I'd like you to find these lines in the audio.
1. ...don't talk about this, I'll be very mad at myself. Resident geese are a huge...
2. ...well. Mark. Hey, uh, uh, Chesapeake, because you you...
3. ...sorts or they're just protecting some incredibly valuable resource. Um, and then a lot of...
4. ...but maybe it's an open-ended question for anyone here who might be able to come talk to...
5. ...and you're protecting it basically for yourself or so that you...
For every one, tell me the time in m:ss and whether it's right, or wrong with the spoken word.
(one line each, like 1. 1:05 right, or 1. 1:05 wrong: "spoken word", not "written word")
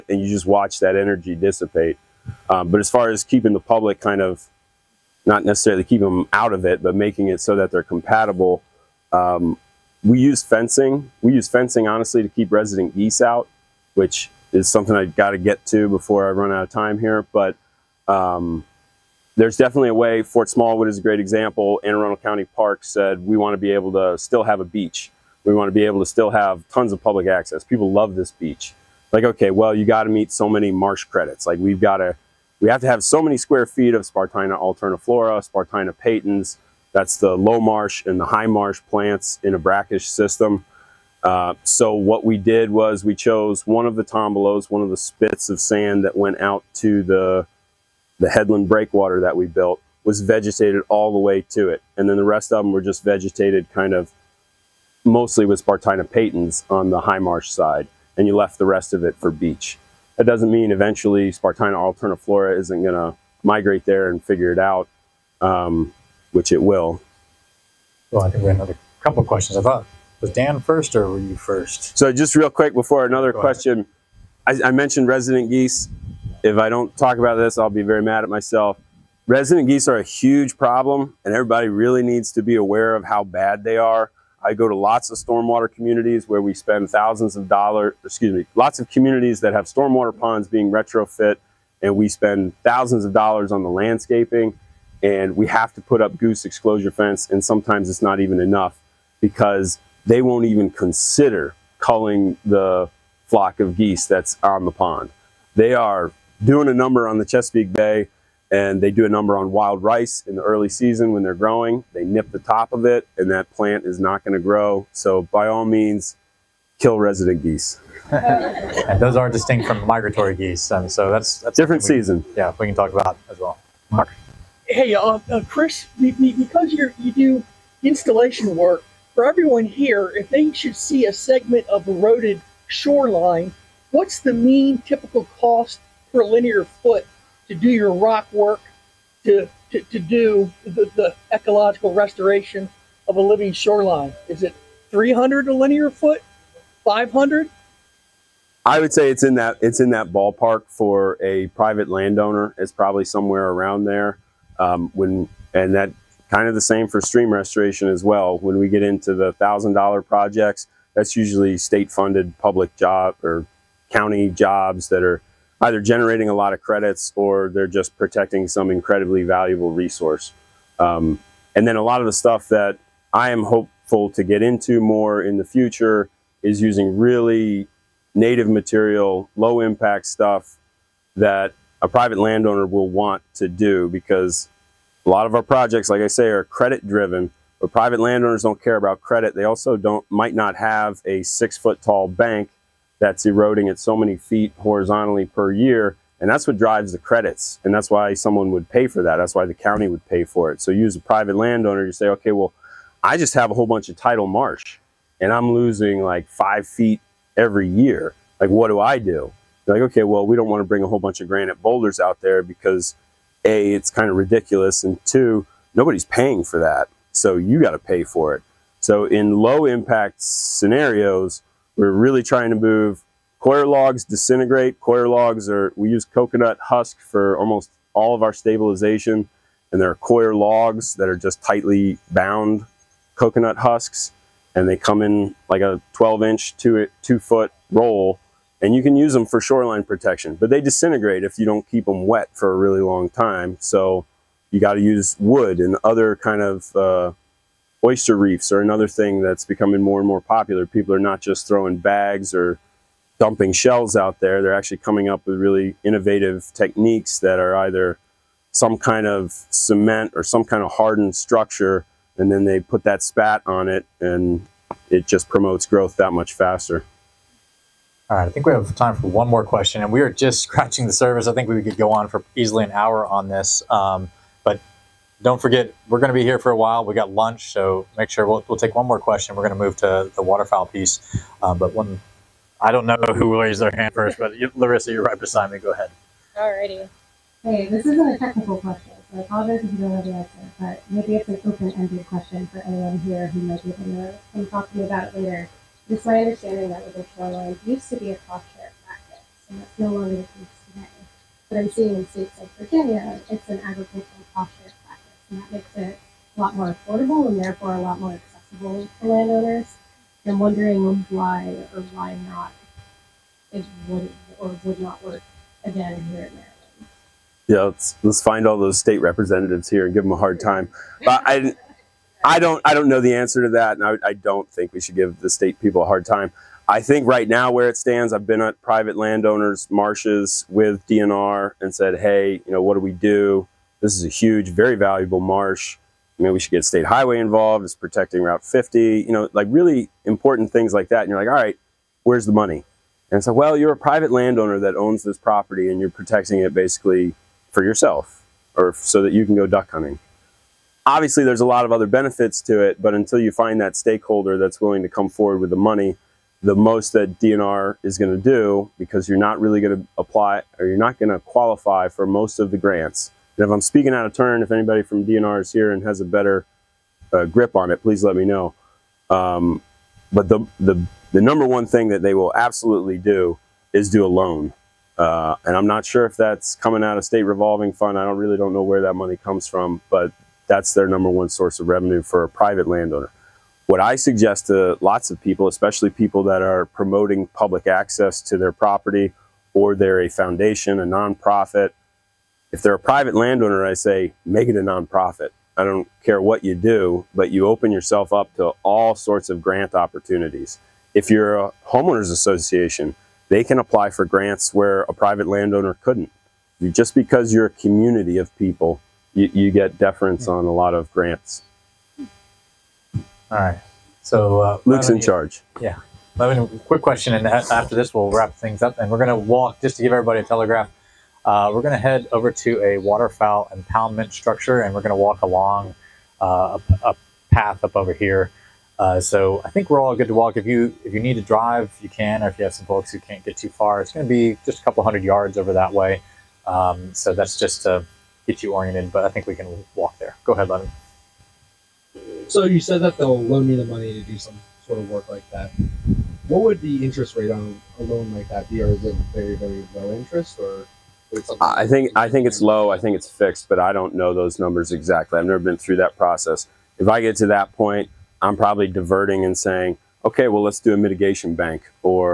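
1. 1:16 right
2. 2:03 wrong: "Chris", not "Chesapeake"
3. 2:46 wrong: "credits", not "sorts"
4. 4:50 right
5. 5:45 right.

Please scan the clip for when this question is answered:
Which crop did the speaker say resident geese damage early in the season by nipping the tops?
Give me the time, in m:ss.
1:49.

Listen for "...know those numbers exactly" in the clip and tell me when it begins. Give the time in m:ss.
7:33.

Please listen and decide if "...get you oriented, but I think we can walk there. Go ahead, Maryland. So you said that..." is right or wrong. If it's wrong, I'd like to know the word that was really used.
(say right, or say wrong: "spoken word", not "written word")
wrong: "Levin", not "Maryland".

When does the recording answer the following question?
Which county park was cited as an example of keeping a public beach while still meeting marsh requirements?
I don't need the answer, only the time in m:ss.
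0:20.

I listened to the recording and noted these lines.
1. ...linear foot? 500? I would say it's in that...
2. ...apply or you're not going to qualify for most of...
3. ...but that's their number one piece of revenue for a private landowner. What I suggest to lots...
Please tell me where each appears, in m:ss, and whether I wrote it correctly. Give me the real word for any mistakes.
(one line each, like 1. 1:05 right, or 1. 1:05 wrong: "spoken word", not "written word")
1. 2:25 right
2. 5:59 right
3. 6:19 wrong: "source", not "piece".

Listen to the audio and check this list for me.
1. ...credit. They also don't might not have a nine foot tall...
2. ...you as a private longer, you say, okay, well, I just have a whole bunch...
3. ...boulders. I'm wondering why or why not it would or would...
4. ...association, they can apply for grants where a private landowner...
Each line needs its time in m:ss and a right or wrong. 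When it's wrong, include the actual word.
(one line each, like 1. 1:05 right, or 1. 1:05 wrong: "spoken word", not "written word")
1. 3:09 wrong: "six", not "nine"
2. 3:20 wrong: "landowner", not "longer"
3. 5:09 wrong: "landowners", not "boulders"
4. 6:42 right.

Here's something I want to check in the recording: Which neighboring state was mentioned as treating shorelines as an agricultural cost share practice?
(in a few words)
Virginia.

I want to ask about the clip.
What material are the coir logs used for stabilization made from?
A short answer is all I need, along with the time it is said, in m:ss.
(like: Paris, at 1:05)
Coconut husk, at 3:46.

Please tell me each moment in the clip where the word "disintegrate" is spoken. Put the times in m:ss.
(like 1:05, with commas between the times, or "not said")
3:44, 4:00.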